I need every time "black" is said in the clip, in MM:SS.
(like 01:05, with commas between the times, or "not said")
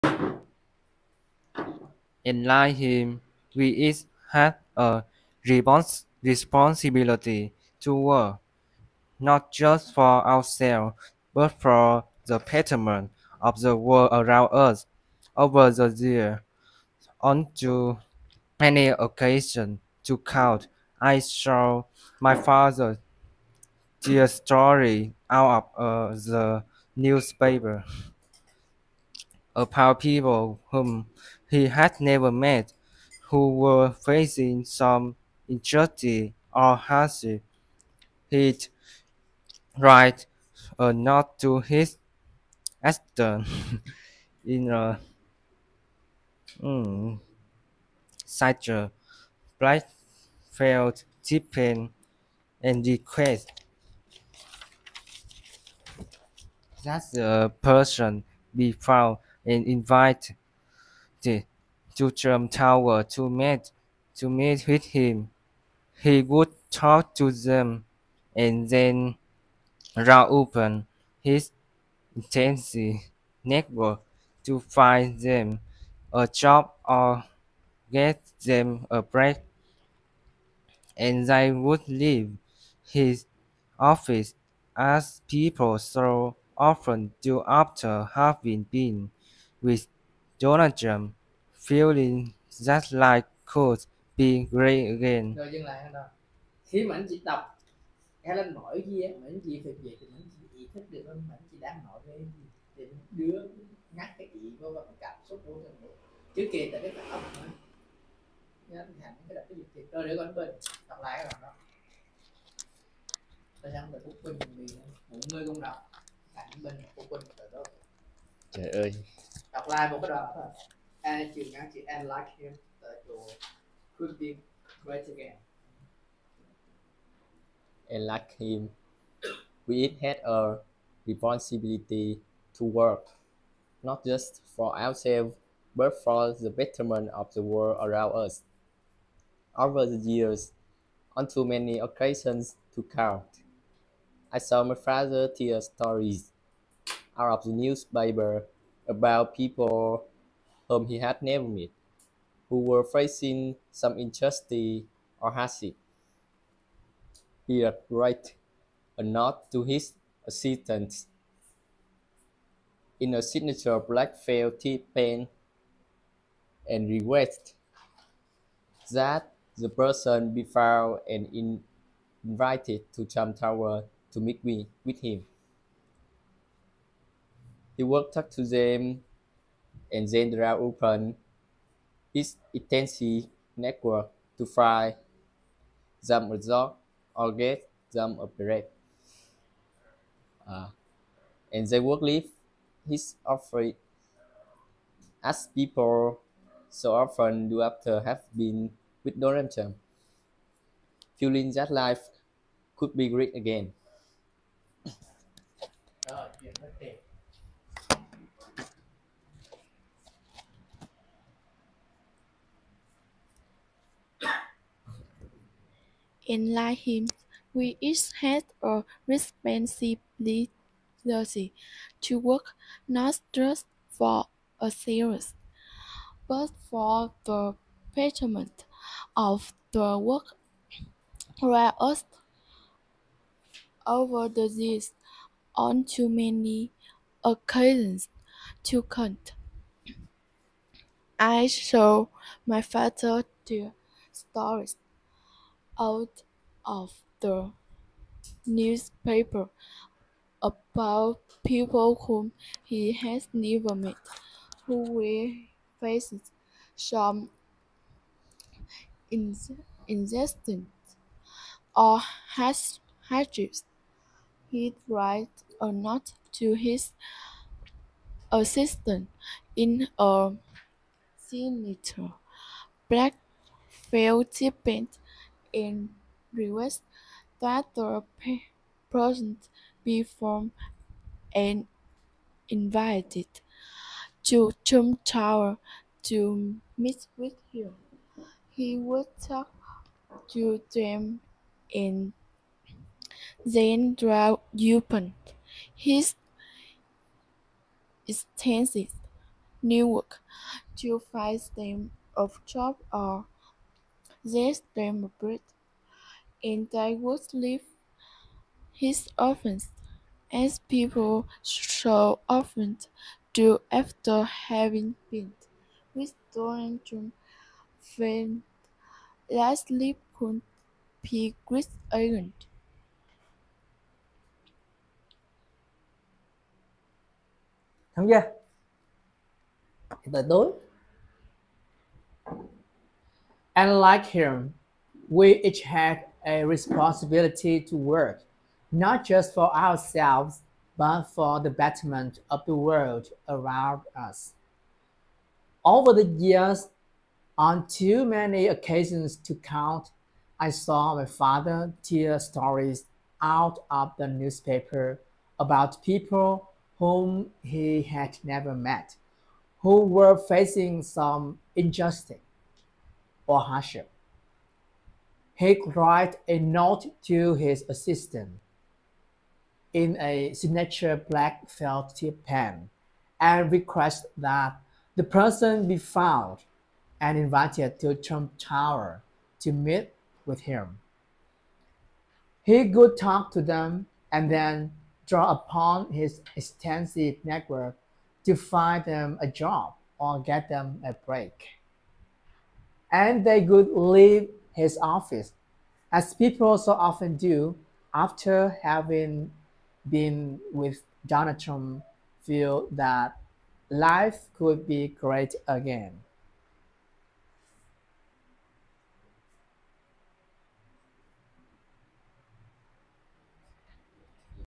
02:43, 04:32, 06:11.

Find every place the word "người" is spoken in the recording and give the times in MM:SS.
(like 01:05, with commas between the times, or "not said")
01:55.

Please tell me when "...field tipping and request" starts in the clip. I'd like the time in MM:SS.
00:50.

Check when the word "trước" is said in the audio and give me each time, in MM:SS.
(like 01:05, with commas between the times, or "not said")
01:46.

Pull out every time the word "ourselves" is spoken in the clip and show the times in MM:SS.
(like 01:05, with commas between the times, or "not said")
00:10, 02:14, 05:39.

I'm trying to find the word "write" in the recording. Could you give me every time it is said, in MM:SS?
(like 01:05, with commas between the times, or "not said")
00:39, 02:37, 04:24, 06:05.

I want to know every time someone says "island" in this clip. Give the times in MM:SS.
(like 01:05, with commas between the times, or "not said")
05:21.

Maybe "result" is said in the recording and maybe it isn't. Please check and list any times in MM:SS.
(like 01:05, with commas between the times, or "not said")
03:06.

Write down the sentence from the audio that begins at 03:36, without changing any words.
In him, we each have a responsibility to work not just for a but for the betterment of the work.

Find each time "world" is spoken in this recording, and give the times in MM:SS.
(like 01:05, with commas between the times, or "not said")
00:13, 02:17, 05:42.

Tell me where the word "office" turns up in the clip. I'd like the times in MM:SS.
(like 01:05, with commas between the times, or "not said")
01:23, 06:34.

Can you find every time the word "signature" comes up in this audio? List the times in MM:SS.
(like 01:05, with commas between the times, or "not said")
02:43, 04:31, 06:10.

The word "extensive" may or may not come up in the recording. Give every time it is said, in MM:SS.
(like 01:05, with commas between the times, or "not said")
04:58, 06:26.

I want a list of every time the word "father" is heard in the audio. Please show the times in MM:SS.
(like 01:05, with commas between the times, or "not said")
00:22, 02:24, 04:02, 05:51.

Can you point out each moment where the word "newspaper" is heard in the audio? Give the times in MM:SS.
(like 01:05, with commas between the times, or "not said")
00:26, 02:27, 04:08, 05:54.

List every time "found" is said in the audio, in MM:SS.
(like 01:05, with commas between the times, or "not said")
00:58, 02:50, 06:15.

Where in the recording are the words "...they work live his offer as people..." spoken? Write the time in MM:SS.
03:11.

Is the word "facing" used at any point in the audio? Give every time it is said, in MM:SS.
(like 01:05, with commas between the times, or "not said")
00:33, 02:32, 04:15, 06:00.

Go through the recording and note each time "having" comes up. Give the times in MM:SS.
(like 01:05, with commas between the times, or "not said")
01:28, 05:14, 06:38.